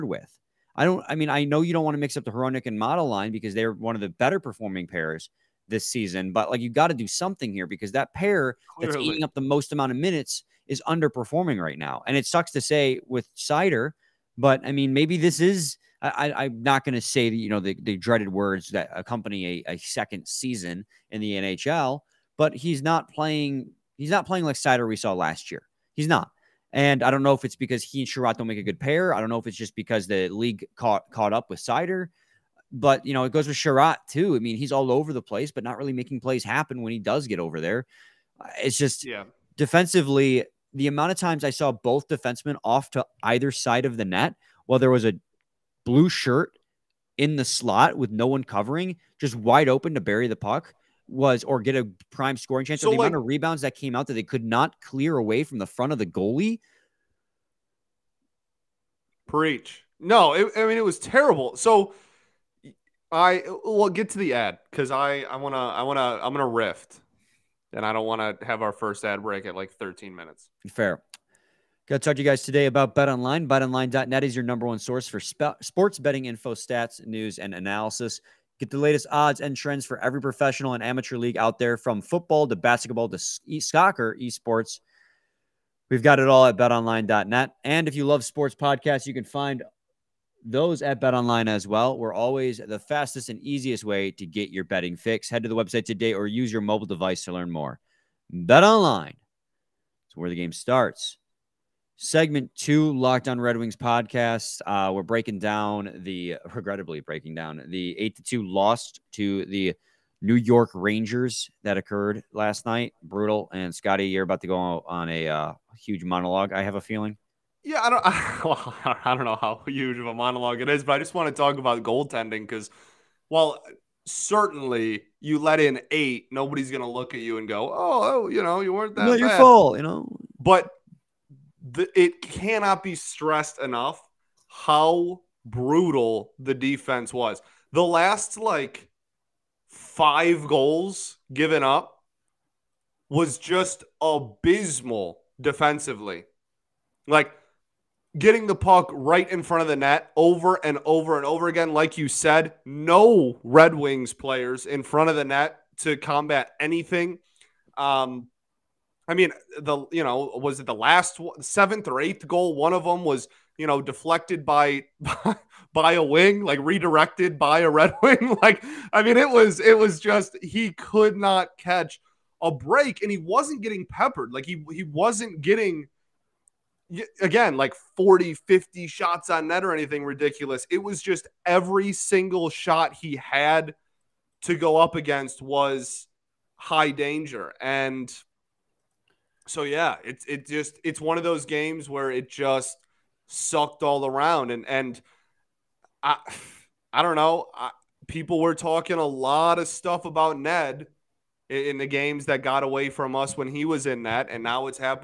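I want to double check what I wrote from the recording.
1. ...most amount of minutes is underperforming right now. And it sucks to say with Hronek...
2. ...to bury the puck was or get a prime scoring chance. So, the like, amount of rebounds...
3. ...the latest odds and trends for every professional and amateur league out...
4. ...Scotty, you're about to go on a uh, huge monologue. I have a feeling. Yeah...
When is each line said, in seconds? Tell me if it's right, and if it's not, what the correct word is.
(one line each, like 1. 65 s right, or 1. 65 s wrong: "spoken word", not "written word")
1. 9 s wrong: "Seider", not "Hronek"
2. 49 s right
3. 78 s right
4. 113 s right.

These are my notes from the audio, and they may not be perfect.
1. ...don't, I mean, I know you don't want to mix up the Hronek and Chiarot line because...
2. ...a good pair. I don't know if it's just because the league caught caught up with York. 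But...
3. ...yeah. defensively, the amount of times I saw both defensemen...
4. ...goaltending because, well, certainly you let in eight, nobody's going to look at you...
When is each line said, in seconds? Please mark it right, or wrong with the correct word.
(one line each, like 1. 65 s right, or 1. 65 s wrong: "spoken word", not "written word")
1. 0 s wrong: "Model", not "Chiarot"
2. 28 s wrong: "Seider", not "York"
3. 39 s right
4. 121 s right.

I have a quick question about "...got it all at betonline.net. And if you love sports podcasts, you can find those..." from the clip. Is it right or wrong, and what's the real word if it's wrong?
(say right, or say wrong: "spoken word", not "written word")
right.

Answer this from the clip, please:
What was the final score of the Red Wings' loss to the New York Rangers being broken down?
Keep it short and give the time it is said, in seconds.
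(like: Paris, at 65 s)
8-2, at 107 s.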